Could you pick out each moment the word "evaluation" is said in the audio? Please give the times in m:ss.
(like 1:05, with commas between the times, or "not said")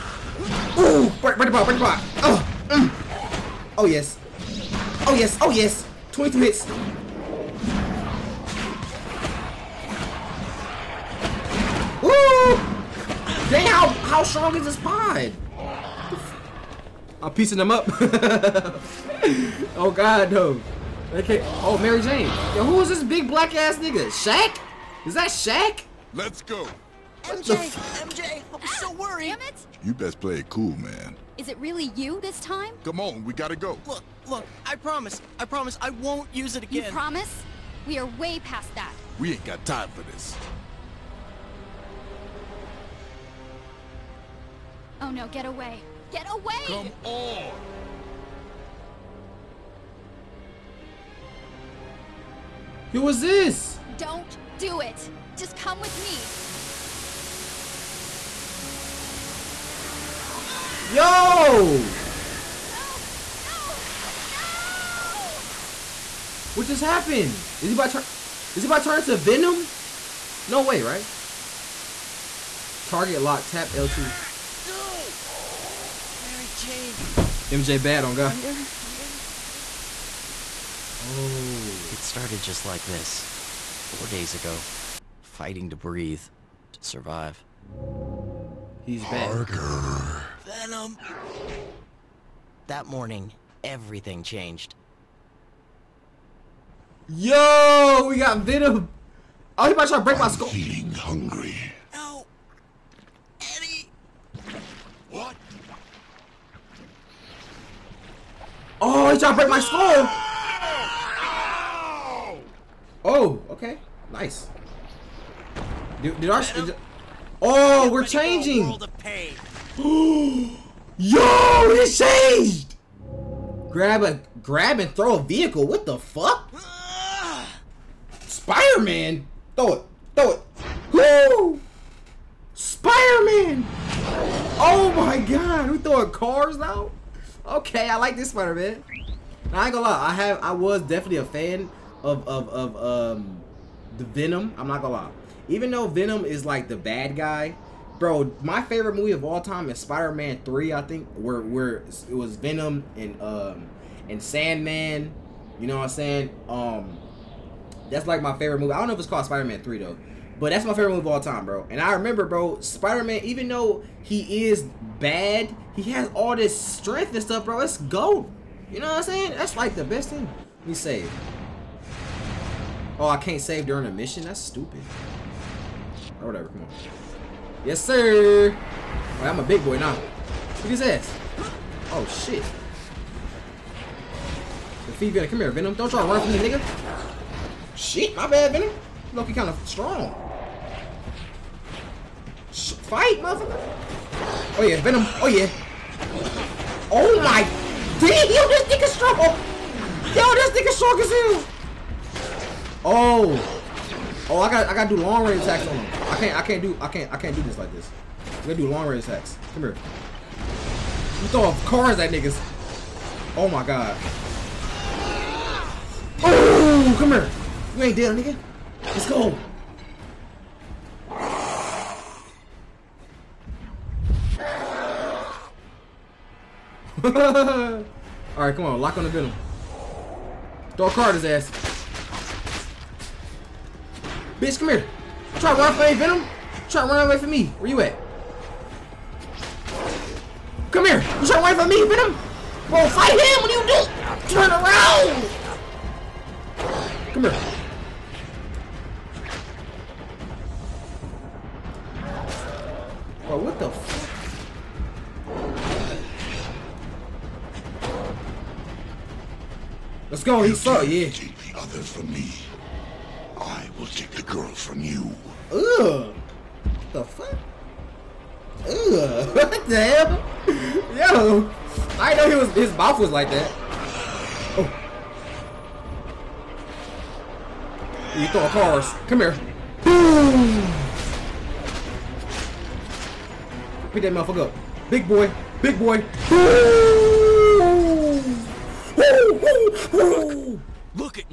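not said.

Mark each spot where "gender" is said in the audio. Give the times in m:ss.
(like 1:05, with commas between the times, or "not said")
not said.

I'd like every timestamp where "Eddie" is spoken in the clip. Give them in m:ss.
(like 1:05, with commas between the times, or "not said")
1:43.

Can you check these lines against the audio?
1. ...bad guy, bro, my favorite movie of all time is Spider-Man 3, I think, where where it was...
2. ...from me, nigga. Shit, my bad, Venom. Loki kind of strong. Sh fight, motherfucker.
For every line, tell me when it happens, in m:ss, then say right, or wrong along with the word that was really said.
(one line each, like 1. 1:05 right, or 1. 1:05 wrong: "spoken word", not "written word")
1. 2:26 right
2. 3:06 right.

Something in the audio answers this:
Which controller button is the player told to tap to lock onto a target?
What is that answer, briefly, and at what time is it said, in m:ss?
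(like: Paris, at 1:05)
L2, at 1:13.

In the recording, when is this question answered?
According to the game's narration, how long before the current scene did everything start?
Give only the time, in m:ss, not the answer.
1:23.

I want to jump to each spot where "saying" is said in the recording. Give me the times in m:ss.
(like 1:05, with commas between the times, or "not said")
2:35, 2:49.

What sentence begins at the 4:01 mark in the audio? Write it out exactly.
You trying to run away from me, Venom?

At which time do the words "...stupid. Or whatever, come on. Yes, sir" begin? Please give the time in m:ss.
2:54.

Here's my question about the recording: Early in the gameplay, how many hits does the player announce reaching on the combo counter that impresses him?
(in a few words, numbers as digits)
22.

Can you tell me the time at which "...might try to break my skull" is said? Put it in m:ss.
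1:39.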